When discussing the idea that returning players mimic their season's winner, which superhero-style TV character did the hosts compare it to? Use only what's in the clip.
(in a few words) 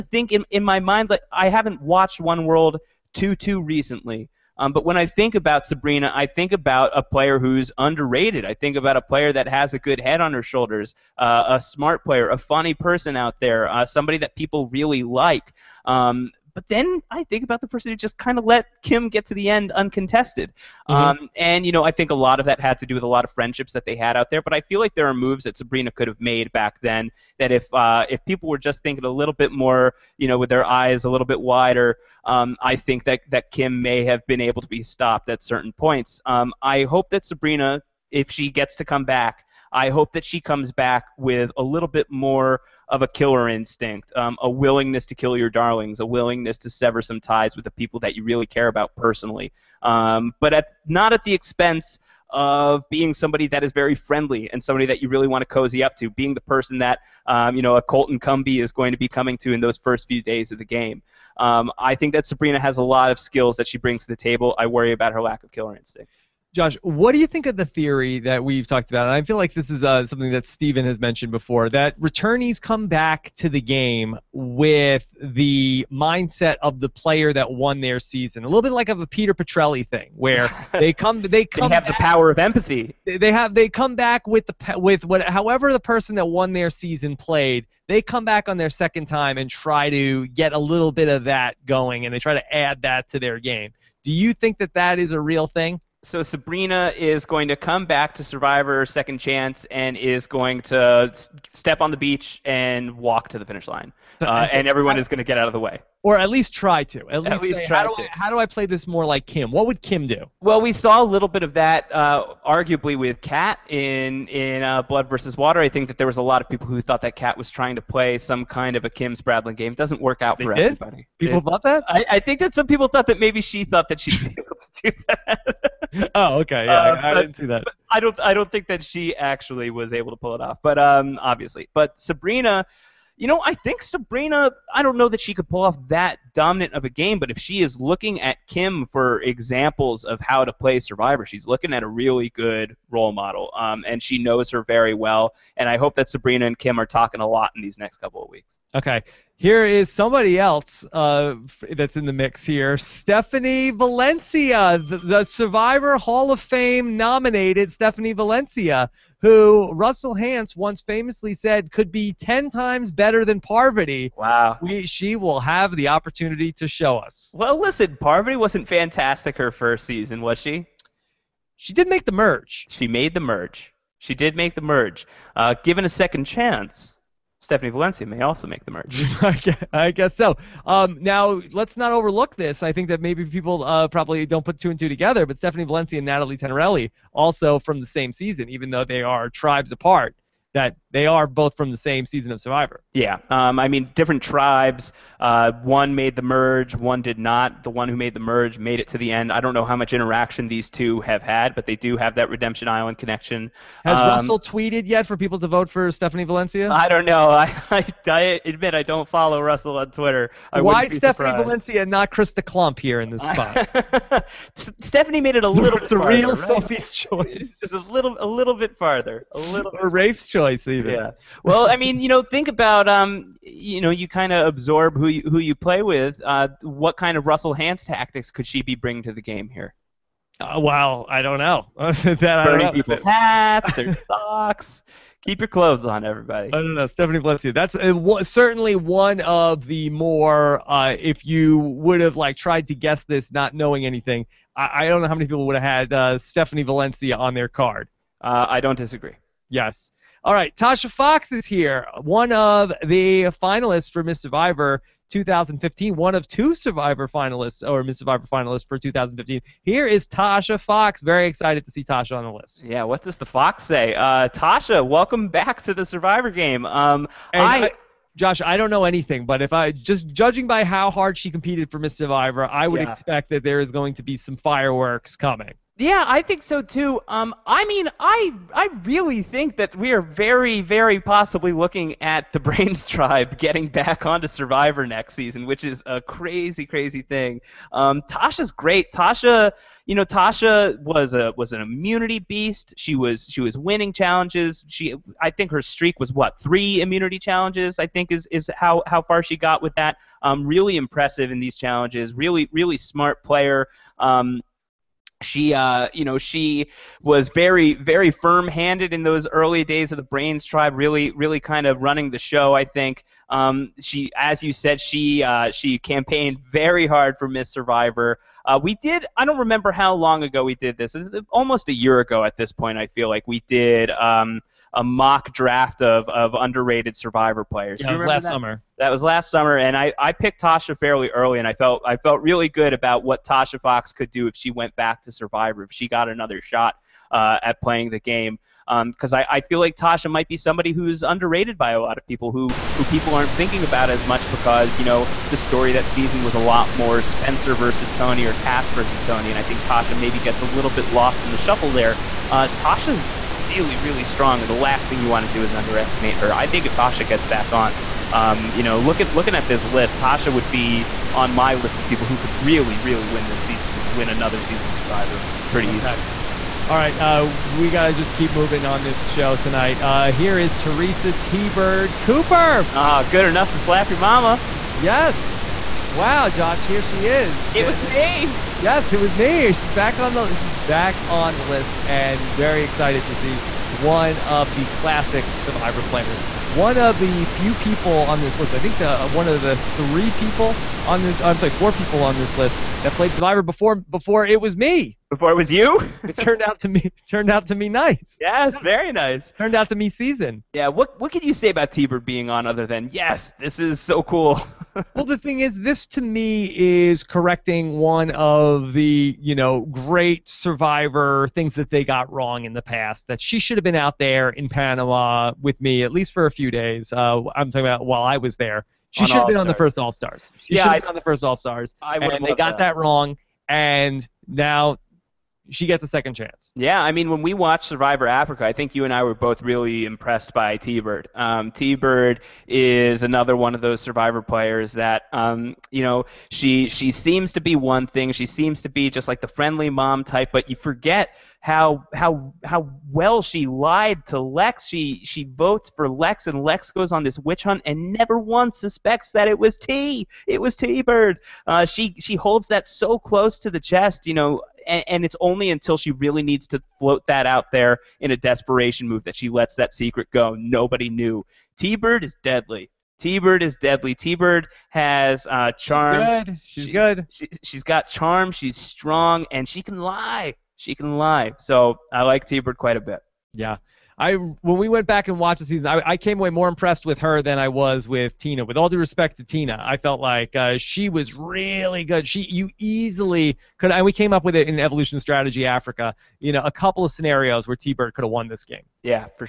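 Peter Petrelli.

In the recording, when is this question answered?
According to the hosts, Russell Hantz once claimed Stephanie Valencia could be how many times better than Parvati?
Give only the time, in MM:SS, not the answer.
02:42.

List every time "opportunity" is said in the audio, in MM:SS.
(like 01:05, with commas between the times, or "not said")
02:45.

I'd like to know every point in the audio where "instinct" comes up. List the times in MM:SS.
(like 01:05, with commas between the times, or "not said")
00:43, 01:05.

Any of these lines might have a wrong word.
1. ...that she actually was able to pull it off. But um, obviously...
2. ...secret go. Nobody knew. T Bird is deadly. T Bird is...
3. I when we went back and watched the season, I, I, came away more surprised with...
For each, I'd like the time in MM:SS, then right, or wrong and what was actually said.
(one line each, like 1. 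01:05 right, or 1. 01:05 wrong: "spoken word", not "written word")
1. 02:08 right
2. 07:39 right
3. 07:53 wrong: "impressed", not "surprised".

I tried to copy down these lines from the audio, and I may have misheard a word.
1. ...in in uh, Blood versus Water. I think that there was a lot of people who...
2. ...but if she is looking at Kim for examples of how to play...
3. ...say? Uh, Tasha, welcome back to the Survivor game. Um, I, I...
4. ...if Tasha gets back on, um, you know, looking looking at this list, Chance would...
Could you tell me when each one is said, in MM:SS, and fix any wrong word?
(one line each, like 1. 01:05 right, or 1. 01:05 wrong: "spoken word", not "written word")
1. 01:53 right
2. 02:17 right
3. 04:23 right
4. 05:56 wrong: "Tasha", not "Chance".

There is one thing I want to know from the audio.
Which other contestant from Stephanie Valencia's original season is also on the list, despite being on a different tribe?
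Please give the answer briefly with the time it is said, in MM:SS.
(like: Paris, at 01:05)
Natalie Tenerelli, at 03:06.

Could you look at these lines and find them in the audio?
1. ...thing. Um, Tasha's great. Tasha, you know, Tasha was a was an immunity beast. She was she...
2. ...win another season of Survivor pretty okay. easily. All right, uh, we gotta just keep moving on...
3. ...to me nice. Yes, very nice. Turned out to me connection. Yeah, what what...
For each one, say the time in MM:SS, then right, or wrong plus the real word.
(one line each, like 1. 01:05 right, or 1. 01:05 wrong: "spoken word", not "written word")
1. 04:47 right
2. 06:03 right
3. 06:37 wrong: "season", not "connection".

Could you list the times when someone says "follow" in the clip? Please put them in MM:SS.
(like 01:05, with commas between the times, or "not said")
03:29.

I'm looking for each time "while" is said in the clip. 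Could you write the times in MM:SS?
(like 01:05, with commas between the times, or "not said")
06:57.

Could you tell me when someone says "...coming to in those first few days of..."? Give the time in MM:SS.
00:59.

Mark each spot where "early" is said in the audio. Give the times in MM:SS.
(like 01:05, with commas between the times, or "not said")
05:09, 05:31.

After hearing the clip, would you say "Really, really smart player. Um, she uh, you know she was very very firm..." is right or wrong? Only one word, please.
right.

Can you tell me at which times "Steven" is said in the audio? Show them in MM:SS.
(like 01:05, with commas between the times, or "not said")
01:10.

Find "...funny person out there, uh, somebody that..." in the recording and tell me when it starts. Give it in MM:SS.
00:12.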